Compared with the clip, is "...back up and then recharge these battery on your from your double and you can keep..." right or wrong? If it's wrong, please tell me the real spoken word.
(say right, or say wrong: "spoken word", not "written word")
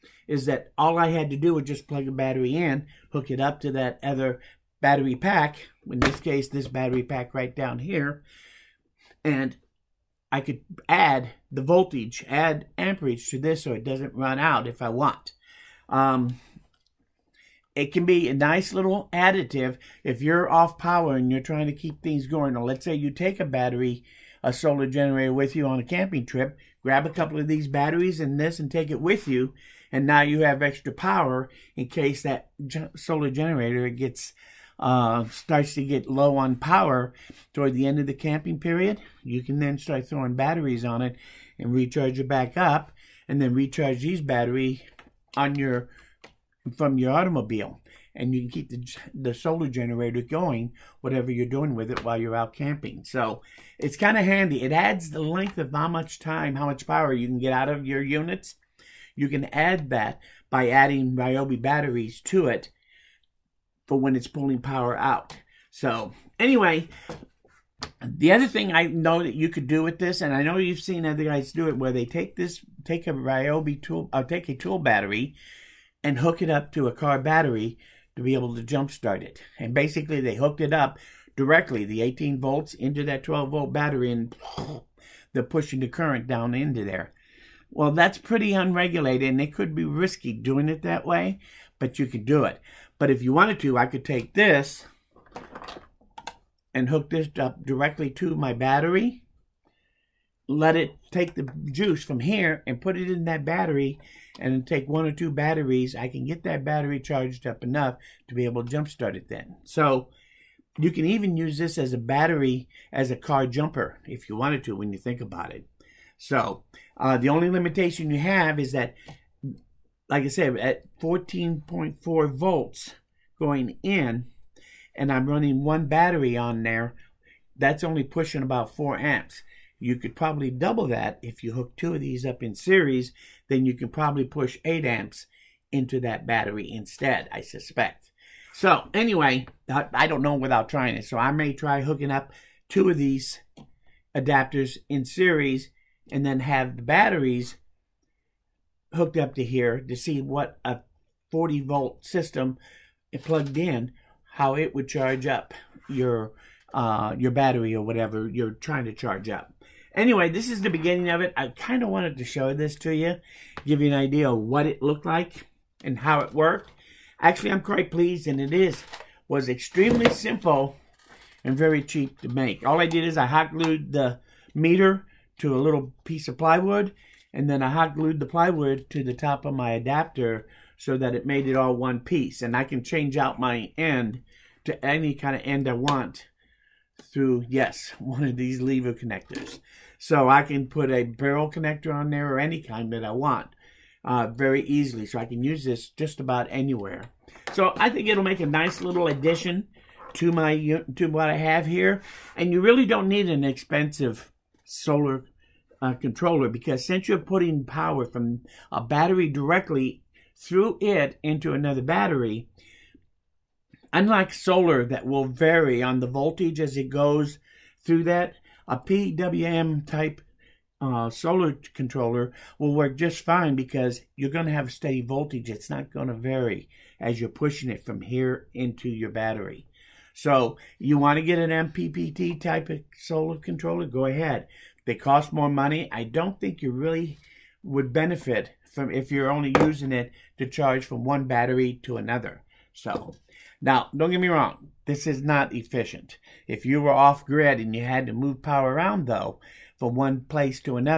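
wrong: "automobile", not "double".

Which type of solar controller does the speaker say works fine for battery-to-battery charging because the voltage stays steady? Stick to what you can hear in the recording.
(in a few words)
PWM.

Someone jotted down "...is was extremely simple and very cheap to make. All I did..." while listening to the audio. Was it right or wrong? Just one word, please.
right.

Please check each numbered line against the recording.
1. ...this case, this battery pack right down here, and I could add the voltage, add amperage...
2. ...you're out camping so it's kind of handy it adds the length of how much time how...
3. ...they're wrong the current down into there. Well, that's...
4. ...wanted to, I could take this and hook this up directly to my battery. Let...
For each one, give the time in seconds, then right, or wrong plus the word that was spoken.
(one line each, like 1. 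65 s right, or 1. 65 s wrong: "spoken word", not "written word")
1. 5 s right
2. 52 s right
3. 85 s wrong: "pushing", not "wrong"
4. 93 s right.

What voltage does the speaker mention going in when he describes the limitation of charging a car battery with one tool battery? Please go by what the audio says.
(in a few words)
14.4 volts.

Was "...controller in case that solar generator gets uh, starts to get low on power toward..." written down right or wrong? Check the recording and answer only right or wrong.
wrong.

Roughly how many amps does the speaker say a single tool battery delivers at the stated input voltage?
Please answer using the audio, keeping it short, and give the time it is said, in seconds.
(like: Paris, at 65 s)
4 amps, at 128 s.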